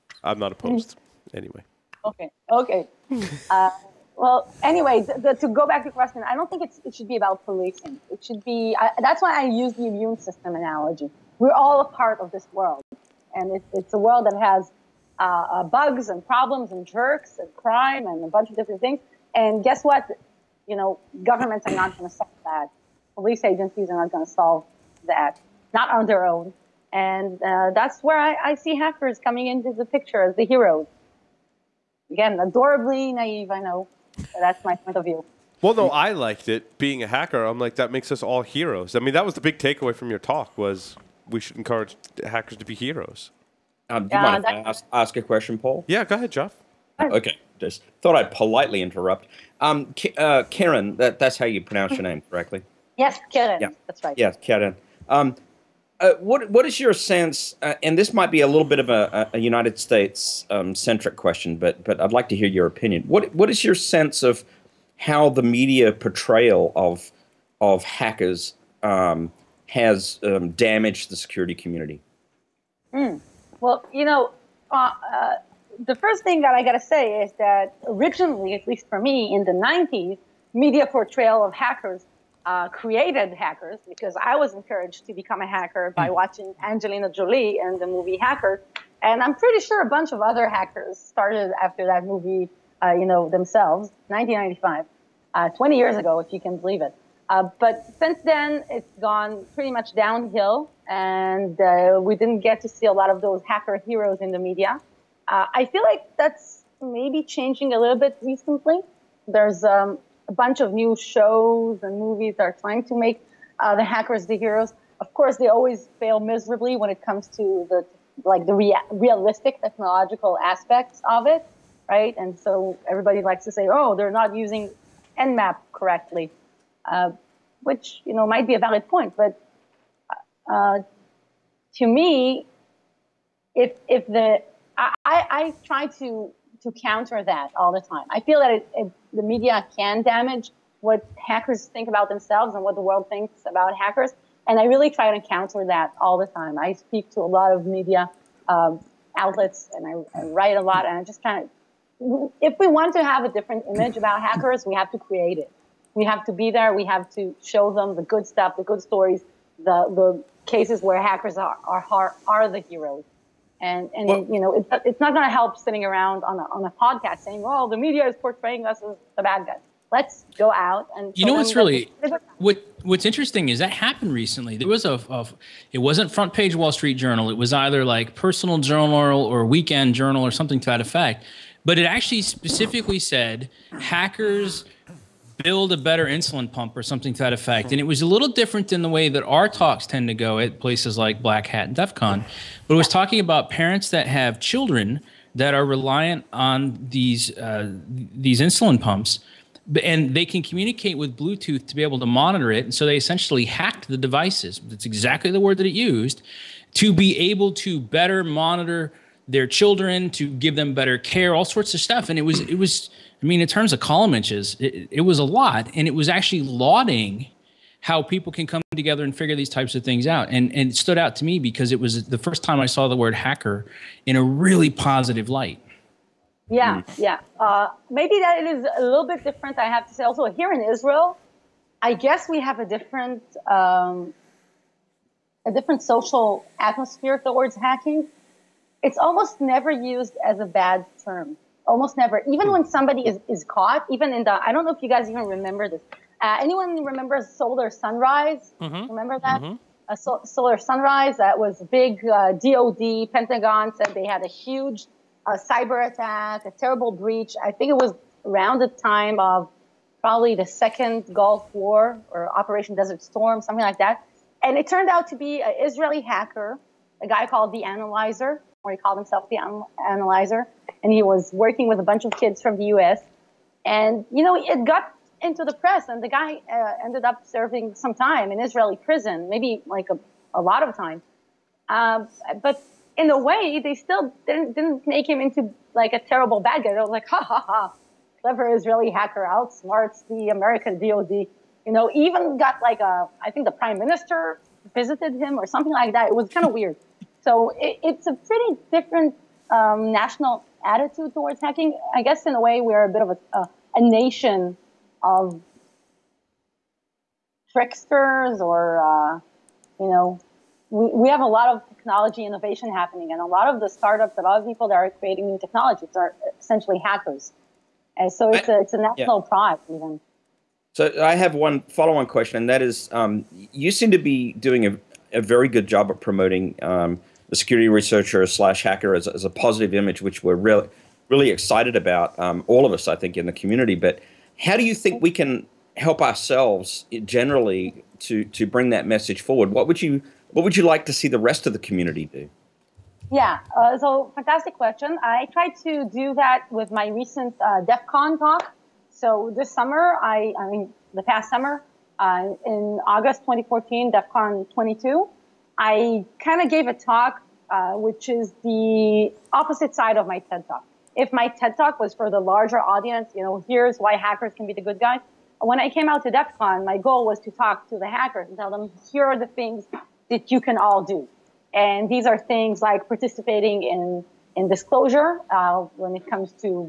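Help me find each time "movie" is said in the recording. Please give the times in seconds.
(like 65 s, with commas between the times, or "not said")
87 s, 92 s, 111 s.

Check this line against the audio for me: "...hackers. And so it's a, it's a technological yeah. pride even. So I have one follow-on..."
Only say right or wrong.
wrong.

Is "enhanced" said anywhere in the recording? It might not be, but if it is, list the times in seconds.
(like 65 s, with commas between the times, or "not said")
not said.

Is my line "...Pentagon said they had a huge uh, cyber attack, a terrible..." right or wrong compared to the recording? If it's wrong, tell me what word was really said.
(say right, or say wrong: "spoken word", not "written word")
right.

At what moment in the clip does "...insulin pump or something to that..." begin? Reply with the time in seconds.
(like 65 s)
186 s.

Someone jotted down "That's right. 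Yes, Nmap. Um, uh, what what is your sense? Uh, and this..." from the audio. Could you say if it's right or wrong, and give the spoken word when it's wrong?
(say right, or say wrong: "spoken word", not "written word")
wrong: "Keren", not "Nmap".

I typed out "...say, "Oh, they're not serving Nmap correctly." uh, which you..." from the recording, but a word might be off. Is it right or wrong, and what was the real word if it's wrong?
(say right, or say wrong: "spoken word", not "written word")
wrong: "using", not "serving".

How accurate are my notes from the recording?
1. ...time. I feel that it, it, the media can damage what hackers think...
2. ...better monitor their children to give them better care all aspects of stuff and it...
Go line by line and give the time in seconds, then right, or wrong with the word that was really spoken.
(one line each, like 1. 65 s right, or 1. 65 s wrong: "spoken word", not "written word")
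1. 137 s right
2. 207 s wrong: "sorts", not "aspects".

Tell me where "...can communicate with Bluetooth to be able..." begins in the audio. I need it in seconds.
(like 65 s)
200 s.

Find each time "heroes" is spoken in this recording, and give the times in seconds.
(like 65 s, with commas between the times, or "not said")
30 s, 38 s, 42 s, 103 s, 114 s, 162 s.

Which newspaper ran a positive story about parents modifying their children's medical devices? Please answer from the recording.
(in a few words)
Wall Street Journal.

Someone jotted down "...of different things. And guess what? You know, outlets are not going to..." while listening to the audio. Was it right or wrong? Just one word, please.
wrong.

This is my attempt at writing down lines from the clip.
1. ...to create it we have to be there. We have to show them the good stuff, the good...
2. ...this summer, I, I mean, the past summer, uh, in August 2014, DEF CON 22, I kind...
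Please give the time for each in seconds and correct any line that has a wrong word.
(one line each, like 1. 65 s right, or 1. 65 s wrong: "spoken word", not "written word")
1. 154 s right
2. 349 s right.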